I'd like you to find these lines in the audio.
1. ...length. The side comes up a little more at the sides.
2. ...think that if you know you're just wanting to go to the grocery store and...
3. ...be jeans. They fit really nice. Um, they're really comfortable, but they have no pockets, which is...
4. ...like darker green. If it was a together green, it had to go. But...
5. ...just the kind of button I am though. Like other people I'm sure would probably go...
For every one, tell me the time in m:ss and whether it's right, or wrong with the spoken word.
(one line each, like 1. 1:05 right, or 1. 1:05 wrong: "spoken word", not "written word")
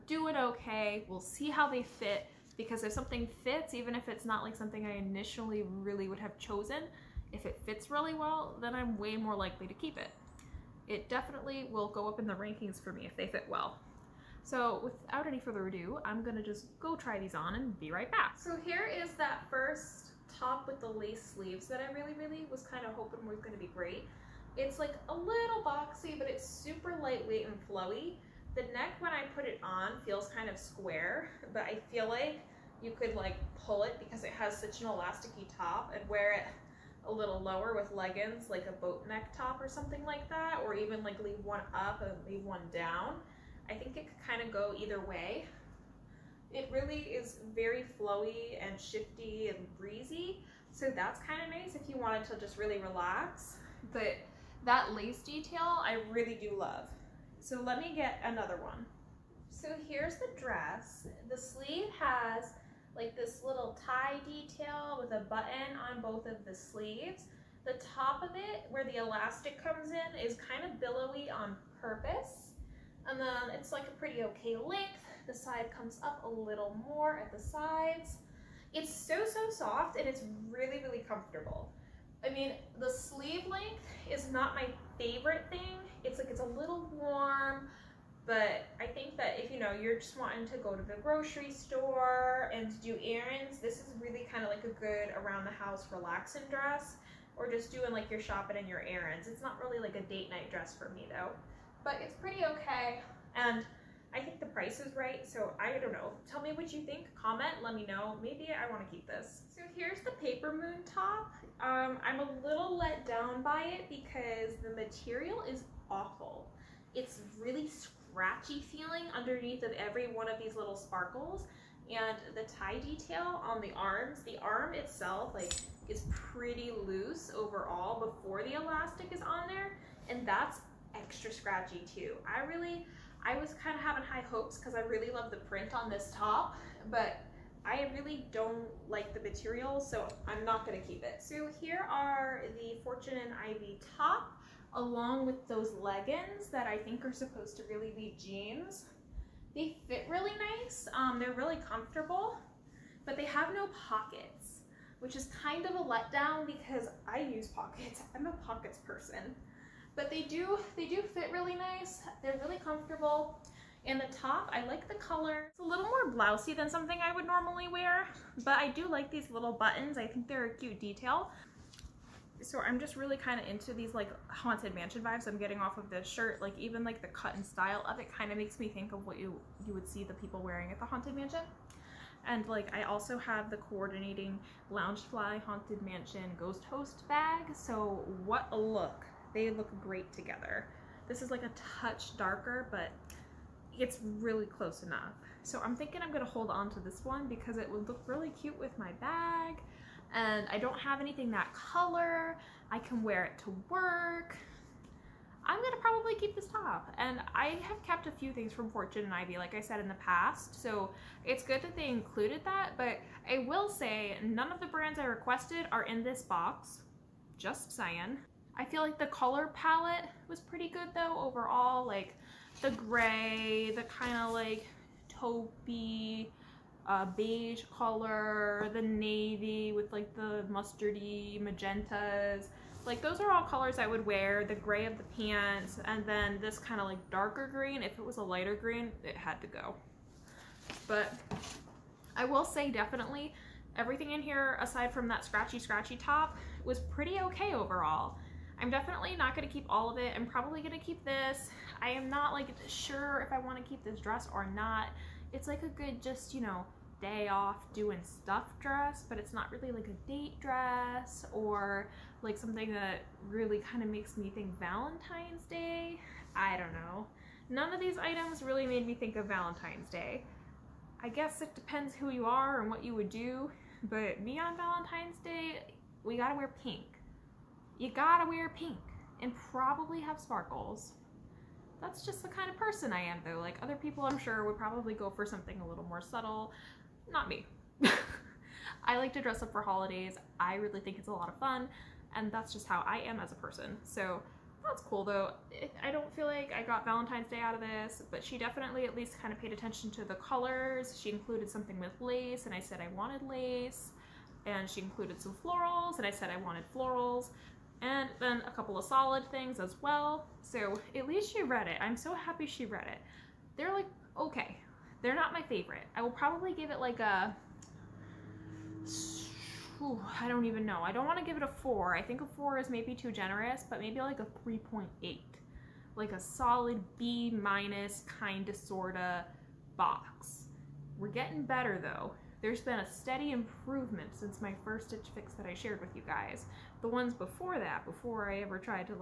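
1. 1:14 right
2. 1:28 right
3. 2:27 right
4. 3:56 wrong: "lighter", not "together"
5. 4:42 wrong: "person", not "button".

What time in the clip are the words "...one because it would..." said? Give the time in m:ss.
3:17.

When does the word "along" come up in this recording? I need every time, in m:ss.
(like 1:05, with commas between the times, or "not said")
2:24.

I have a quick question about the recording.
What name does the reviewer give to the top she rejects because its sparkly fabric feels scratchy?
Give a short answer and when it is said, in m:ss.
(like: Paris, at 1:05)
Paper Moon, at 1:50.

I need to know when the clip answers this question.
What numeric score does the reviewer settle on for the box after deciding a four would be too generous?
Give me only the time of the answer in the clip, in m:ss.
5:24.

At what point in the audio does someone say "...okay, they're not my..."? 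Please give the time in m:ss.
5:14.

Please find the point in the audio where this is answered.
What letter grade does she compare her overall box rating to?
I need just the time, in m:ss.
5:26.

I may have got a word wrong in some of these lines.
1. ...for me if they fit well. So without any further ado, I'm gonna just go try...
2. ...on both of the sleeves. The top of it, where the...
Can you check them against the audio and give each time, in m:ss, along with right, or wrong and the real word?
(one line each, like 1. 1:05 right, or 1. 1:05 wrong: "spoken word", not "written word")
1. 0:12 right
2. 1:05 right.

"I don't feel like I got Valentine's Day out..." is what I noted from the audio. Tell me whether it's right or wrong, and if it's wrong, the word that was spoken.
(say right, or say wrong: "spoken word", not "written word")
right.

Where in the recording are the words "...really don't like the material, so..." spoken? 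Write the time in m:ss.
2:17.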